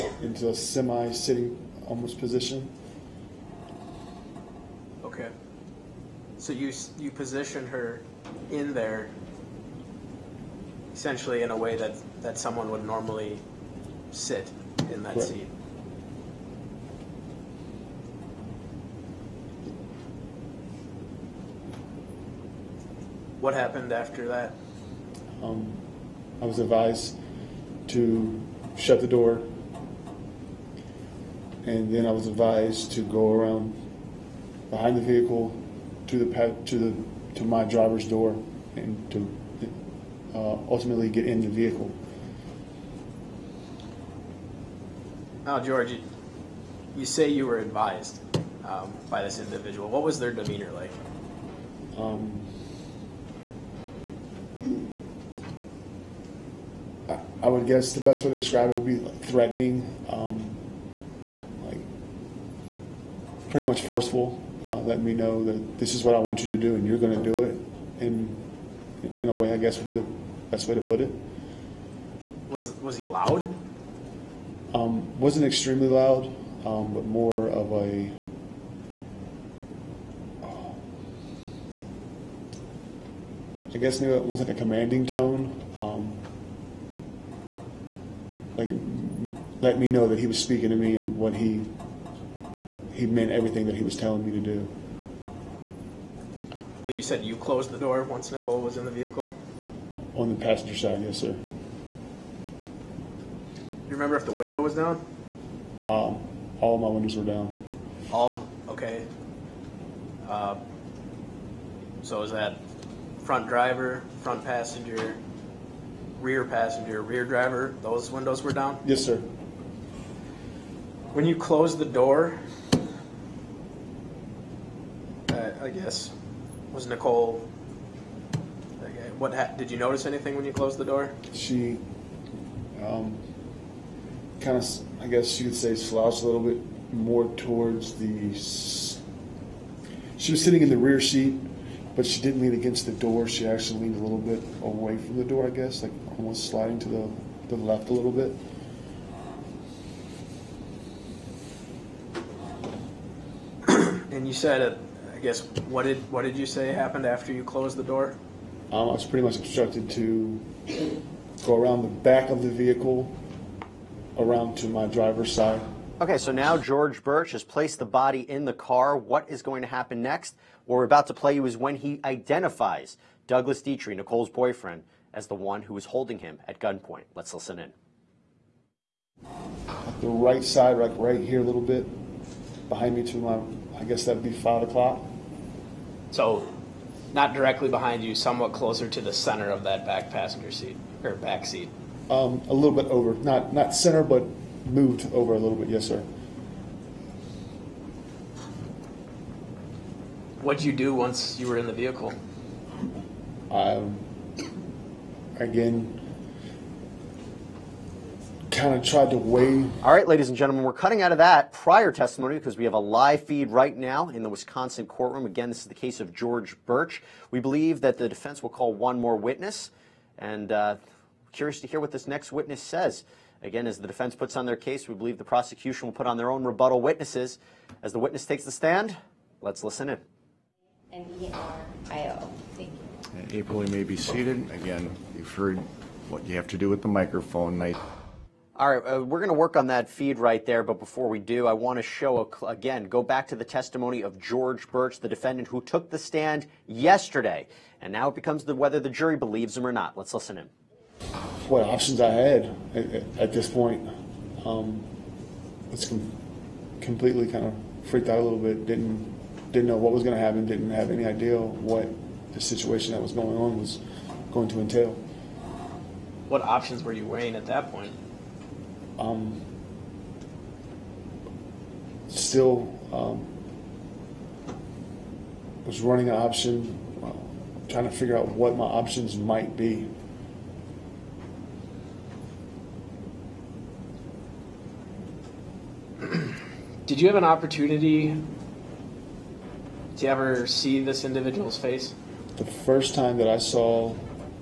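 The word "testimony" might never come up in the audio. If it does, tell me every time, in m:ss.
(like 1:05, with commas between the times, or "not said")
3:31, 4:03.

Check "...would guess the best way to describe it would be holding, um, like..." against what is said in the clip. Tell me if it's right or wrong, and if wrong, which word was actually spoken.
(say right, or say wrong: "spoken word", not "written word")
wrong: "threatening", not "holding".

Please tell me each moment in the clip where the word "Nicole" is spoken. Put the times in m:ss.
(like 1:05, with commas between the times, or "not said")
1:38, 2:06, 2:53.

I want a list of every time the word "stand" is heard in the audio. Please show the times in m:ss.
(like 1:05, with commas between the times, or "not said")
3:48, 4:05.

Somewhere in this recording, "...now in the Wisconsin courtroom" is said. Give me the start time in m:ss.
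3:33.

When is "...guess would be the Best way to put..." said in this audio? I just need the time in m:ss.
1:09.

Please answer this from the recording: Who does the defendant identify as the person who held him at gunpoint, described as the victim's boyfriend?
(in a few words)
Douglas Dietrich.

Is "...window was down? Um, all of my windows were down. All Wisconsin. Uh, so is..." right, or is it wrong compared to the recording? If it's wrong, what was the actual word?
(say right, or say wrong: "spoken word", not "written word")
wrong: "Okay", not "Wisconsin".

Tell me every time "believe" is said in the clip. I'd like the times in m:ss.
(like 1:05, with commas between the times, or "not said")
1:36, 3:37, 3:44, 4:09.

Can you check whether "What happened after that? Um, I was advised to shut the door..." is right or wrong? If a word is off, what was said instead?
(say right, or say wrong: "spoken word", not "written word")
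right.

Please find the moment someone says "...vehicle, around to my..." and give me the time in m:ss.
2:42.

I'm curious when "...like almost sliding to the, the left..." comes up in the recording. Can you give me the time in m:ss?
2:25.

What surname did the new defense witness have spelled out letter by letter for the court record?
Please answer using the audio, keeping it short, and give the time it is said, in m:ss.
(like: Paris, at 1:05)
Nerio, at 3:50.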